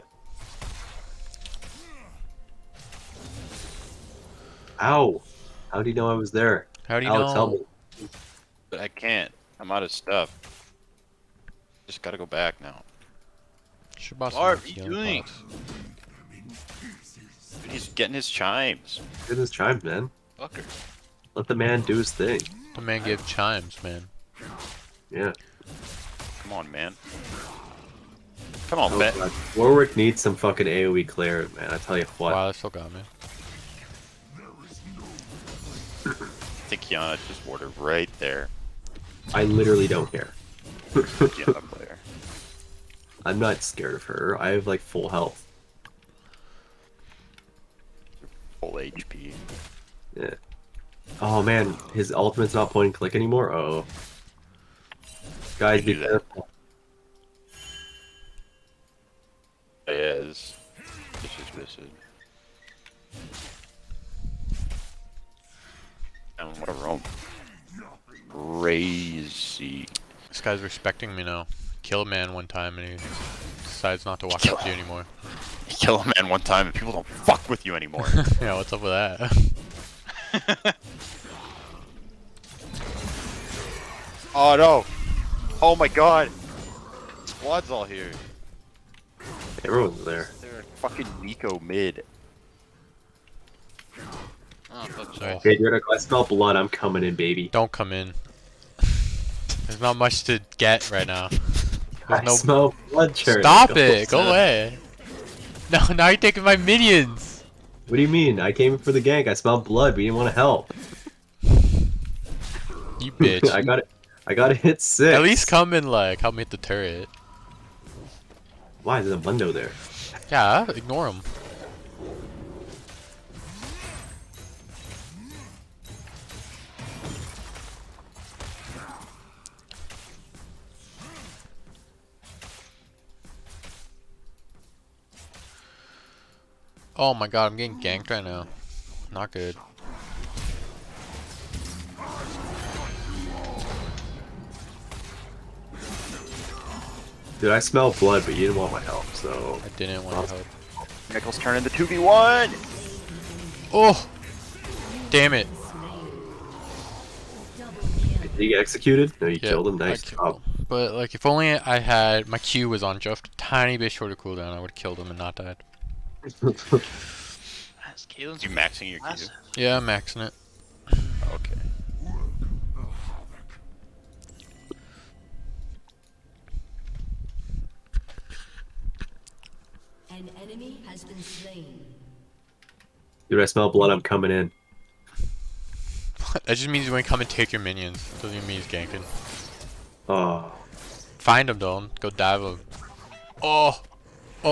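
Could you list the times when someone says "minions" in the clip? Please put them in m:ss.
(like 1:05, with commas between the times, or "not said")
1:46, 3:07.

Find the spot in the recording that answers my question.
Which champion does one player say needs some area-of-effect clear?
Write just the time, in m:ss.
0:29.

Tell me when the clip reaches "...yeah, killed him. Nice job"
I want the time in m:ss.
2:39.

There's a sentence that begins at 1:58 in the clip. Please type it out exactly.
Why is there a window there?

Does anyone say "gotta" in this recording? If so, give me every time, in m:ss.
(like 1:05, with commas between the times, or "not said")
0:12, 1:54.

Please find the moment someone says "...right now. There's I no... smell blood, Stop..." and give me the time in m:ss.
1:40.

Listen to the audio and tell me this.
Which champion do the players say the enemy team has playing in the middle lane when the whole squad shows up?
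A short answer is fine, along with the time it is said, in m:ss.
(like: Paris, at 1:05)
Neeko, at 1:31.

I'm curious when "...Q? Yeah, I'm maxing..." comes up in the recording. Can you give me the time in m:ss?
2:48.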